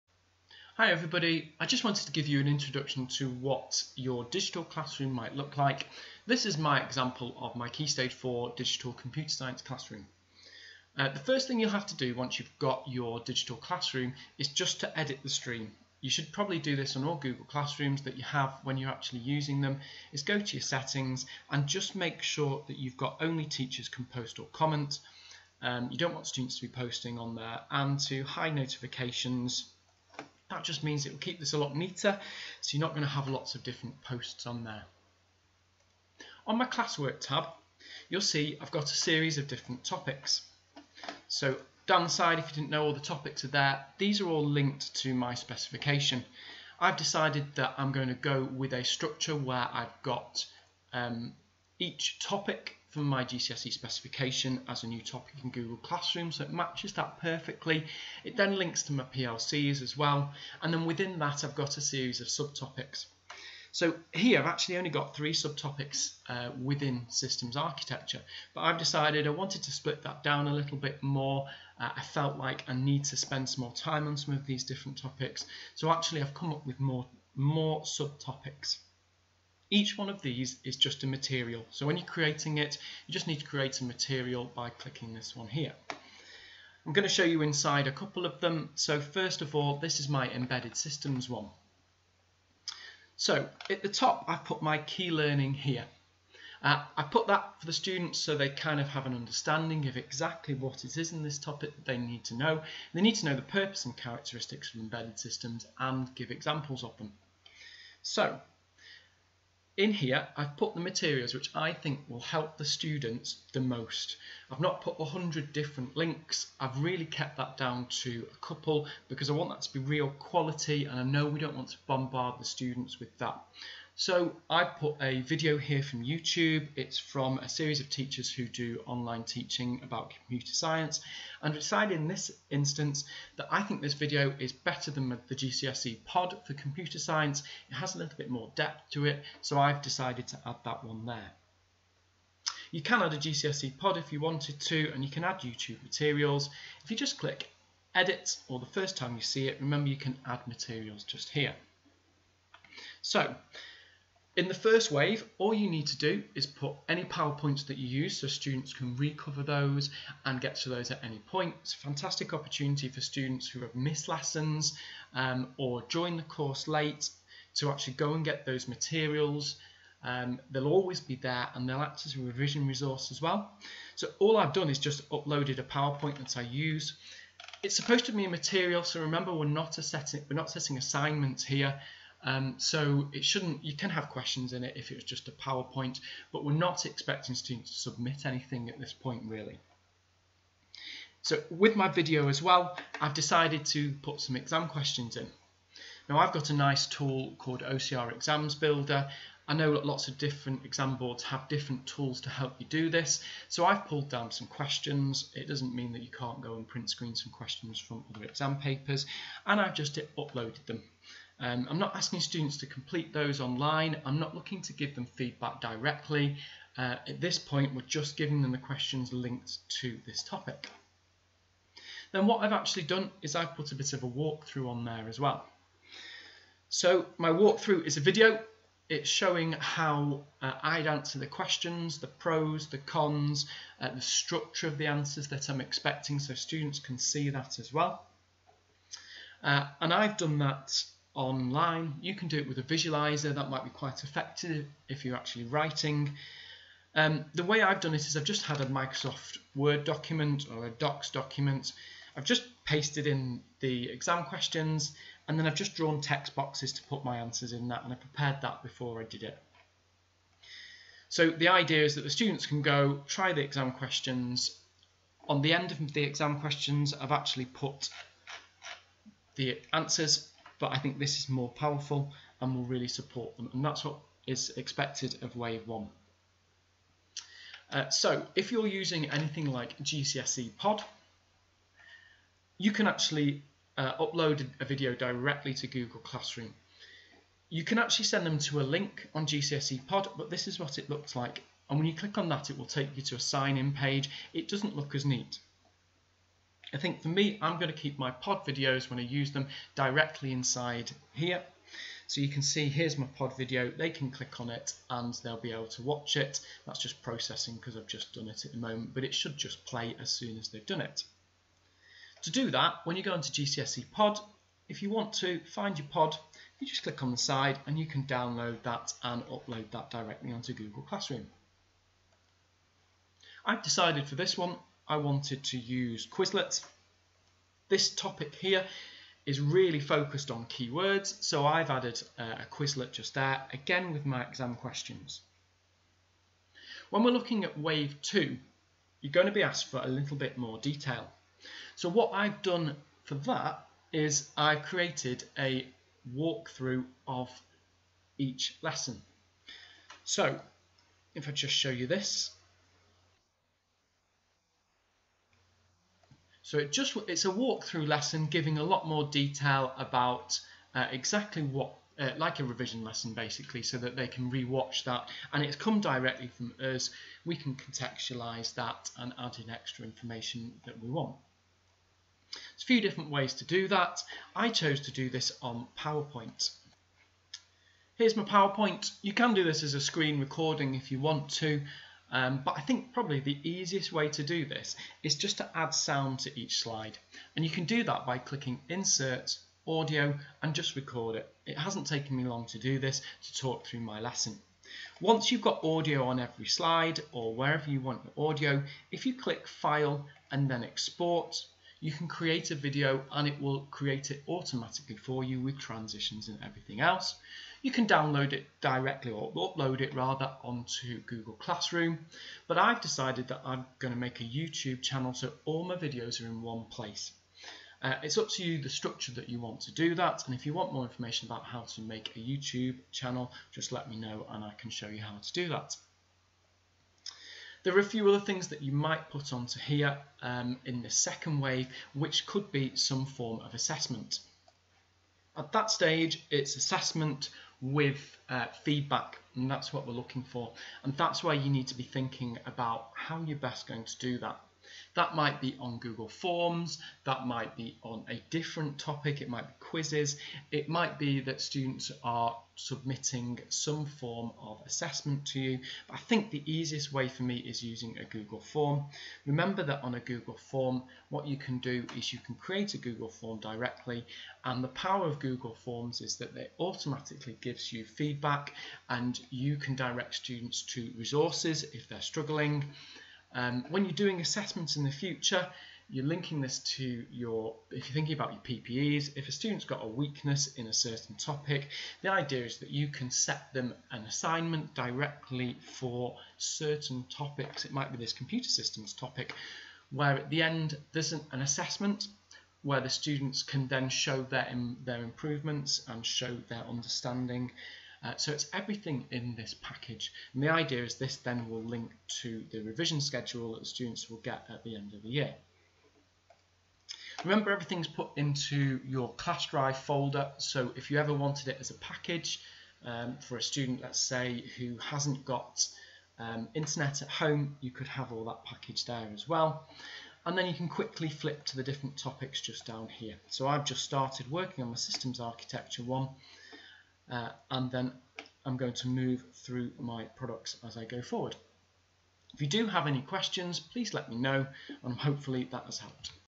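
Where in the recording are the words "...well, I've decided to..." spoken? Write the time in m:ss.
3:12.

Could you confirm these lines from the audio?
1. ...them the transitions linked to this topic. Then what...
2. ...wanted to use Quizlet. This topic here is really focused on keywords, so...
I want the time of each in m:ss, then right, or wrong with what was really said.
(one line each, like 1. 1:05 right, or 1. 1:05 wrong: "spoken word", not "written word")
1. 3:38 wrong: "questions", not "transitions"
2. 5:24 right.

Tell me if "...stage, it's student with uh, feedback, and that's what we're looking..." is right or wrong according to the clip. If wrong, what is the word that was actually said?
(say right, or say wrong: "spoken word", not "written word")
wrong: "assessment", not "student".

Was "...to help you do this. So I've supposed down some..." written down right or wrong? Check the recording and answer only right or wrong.
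wrong.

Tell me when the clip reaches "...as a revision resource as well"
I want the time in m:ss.
2:52.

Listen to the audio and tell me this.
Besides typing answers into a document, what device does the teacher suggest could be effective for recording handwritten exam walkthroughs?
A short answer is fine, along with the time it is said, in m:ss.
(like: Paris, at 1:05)
A visualizer, at 4:02.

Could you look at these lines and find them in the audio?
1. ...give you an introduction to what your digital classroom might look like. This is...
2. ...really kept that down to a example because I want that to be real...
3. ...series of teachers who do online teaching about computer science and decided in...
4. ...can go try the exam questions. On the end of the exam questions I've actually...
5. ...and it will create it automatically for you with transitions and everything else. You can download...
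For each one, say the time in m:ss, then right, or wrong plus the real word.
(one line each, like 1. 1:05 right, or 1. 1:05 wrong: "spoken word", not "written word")
1. 0:02 right
2. 1:56 wrong: "couple", not "example"
3. 2:07 right
4. 4:22 right
5. 6:43 right.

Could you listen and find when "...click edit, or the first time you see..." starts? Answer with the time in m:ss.
2:27.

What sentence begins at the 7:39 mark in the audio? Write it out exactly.
Remember that on a Google form, what you can do is you can create a Google form directly.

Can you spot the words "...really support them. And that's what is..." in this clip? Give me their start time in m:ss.
4:32.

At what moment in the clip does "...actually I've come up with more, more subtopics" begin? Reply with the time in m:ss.
1:15.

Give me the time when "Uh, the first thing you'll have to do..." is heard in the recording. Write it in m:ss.
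0:10.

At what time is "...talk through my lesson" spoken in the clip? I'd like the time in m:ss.
6:33.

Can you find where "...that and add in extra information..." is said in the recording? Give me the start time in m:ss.
6:08.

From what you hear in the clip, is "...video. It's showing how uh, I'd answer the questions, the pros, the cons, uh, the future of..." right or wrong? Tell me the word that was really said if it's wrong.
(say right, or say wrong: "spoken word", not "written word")
wrong: "structure", not "future".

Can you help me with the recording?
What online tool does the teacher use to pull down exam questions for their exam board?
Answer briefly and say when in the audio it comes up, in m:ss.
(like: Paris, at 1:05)
OCR Exams Builder, at 3:17.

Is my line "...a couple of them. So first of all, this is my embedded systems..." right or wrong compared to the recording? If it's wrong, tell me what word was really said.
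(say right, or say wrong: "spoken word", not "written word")
right.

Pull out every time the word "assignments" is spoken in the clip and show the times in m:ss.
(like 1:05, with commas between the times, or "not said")
3:00, 8:04.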